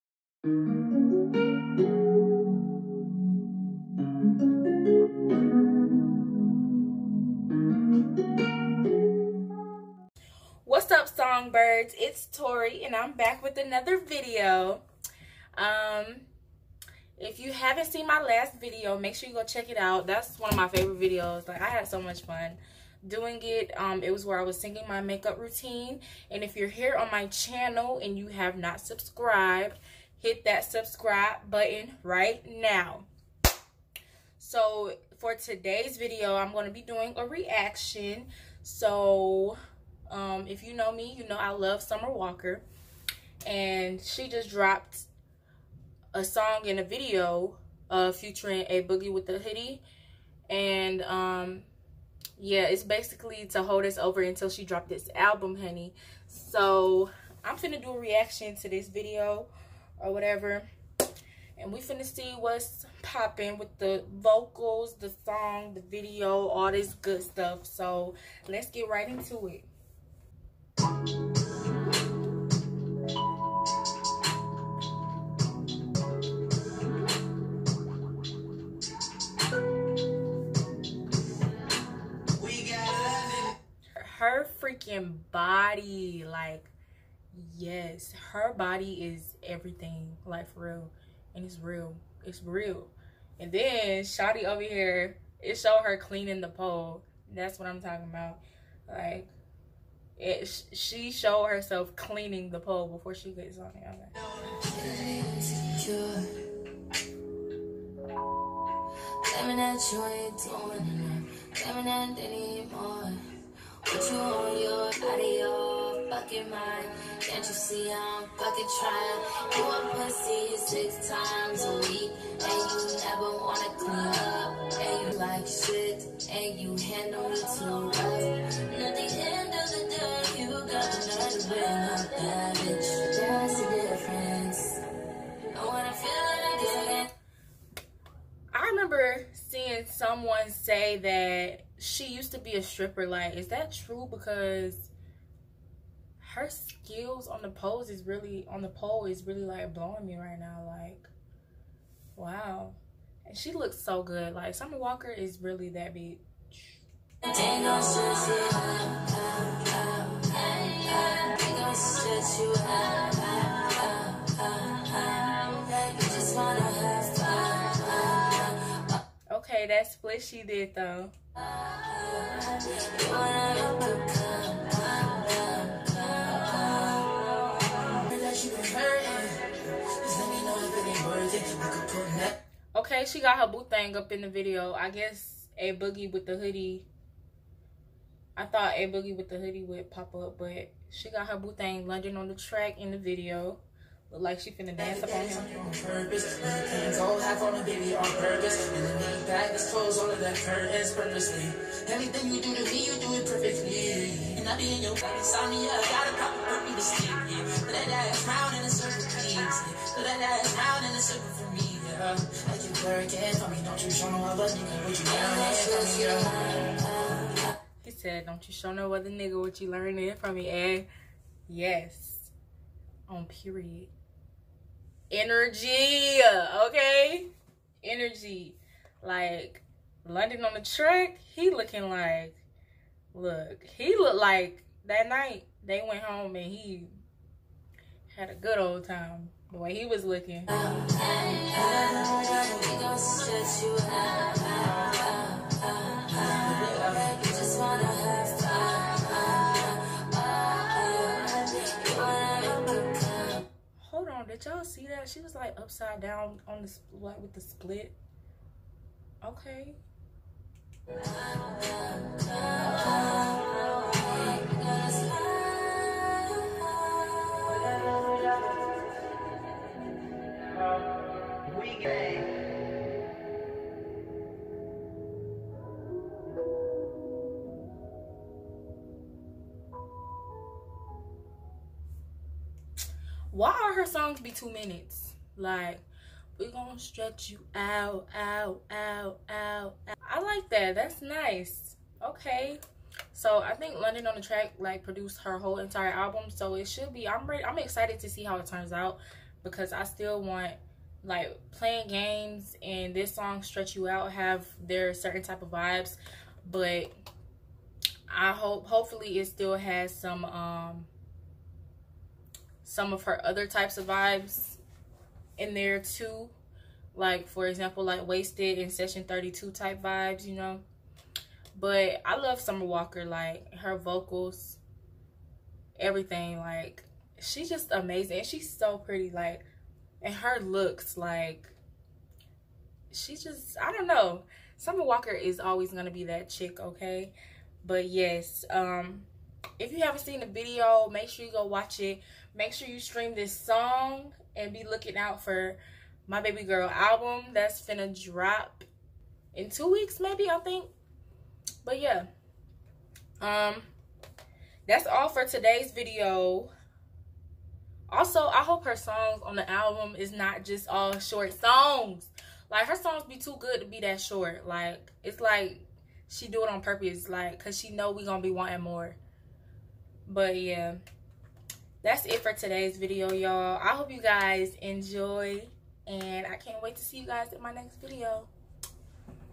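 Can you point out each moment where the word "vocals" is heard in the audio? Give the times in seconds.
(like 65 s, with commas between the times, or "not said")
64 s, 323 s.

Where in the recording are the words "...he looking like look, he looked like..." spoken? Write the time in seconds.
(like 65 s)
231 s.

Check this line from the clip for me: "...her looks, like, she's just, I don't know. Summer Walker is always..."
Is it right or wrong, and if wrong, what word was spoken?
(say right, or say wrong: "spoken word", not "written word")
right.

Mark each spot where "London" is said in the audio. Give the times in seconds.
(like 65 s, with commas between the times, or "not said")
191 s, 230 s, 293 s.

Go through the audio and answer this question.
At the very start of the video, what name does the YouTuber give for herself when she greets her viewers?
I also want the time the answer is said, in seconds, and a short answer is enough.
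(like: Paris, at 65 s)
Torii, at 12 s.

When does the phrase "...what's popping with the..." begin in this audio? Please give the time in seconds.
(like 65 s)
62 s.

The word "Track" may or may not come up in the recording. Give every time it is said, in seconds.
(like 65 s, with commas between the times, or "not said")
192 s, 230 s, 294 s.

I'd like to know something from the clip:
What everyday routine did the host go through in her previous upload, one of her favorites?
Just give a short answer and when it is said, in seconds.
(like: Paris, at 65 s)
makeup routine, at 25 s.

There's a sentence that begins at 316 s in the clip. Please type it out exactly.
Like, for example, like Wasted and Session 32 type vibes, you know.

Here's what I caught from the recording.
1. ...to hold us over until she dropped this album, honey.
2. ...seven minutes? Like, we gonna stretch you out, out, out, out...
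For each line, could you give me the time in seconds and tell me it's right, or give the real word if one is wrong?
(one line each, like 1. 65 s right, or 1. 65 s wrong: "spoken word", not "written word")
1. 53 s right
2. 284 s wrong: "two", not "seven".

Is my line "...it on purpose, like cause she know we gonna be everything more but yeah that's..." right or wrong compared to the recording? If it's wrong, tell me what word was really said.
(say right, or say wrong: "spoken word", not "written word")
wrong: "wanting", not "everything".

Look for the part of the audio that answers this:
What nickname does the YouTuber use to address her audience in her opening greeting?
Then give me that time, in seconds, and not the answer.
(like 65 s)
11 s.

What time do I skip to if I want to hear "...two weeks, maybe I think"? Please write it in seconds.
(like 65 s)
349 s.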